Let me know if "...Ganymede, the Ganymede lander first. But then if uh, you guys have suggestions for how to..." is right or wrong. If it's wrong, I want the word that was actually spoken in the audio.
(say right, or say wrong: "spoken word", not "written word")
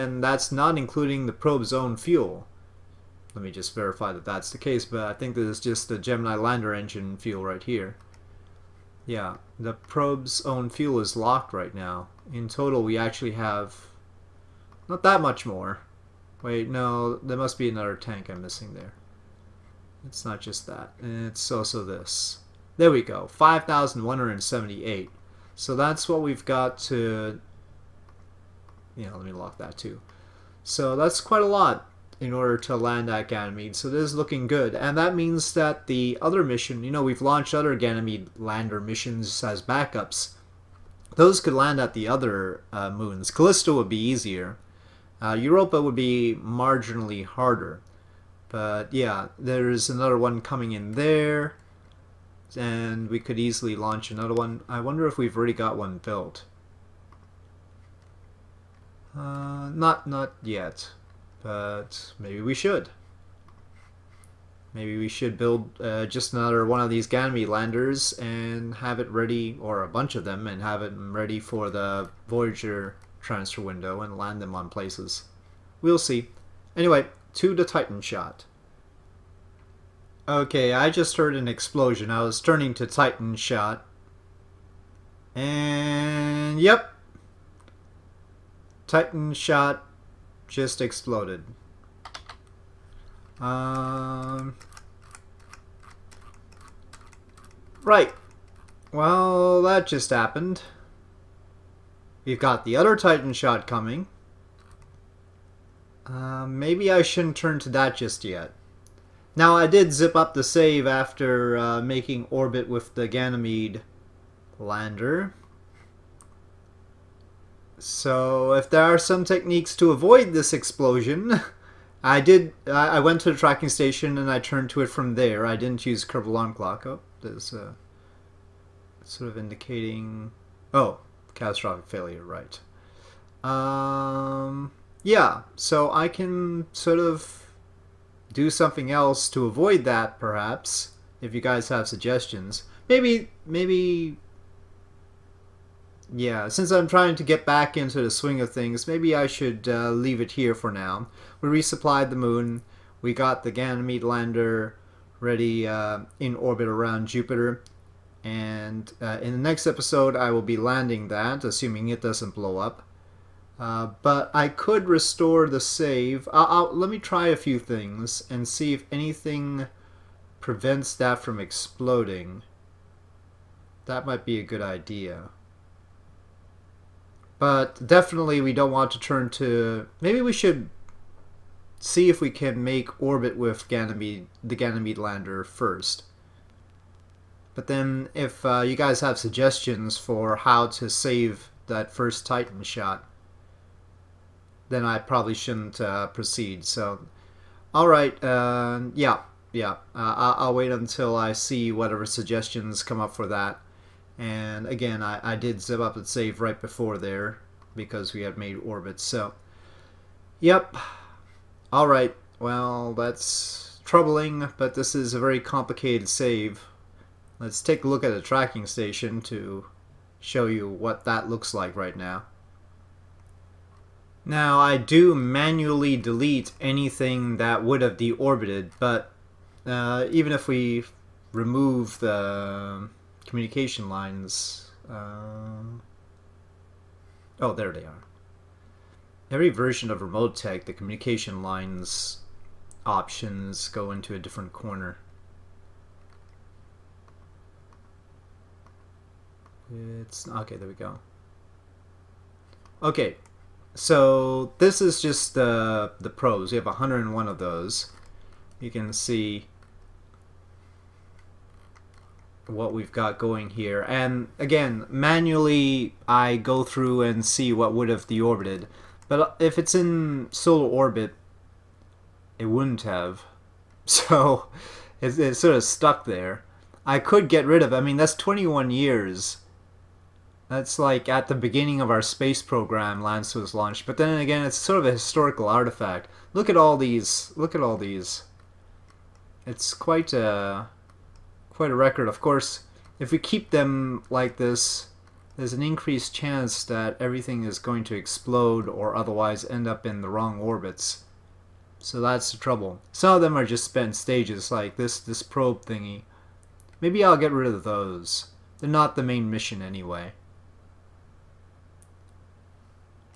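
right.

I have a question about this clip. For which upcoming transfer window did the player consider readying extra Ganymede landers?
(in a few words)
Voyager transfer window.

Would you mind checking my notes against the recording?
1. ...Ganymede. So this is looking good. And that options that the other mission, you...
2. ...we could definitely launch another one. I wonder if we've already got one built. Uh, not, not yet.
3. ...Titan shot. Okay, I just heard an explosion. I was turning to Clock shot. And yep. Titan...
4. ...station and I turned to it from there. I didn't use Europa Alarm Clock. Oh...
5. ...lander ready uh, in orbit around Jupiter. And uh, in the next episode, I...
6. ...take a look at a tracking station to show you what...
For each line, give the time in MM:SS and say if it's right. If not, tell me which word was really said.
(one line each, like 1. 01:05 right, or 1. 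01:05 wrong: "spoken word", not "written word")
1. 00:33 wrong: "means", not "options"
2. 00:53 wrong: "easily", not "definitely"
3. 01:17 wrong: "Titan", not "Clock"
4. 02:03 wrong: "Kerbal", not "Europa"
5. 02:34 right
6. 03:37 right.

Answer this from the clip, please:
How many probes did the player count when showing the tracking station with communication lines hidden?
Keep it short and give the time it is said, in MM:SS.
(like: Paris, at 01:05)
101, at 04:16.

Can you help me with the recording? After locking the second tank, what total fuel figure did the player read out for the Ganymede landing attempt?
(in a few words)
5,178.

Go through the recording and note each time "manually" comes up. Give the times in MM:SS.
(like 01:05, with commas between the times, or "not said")
03:45, 04:24.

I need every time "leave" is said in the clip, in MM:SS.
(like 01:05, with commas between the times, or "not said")
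02:29.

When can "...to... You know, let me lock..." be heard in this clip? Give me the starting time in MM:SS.
00:26.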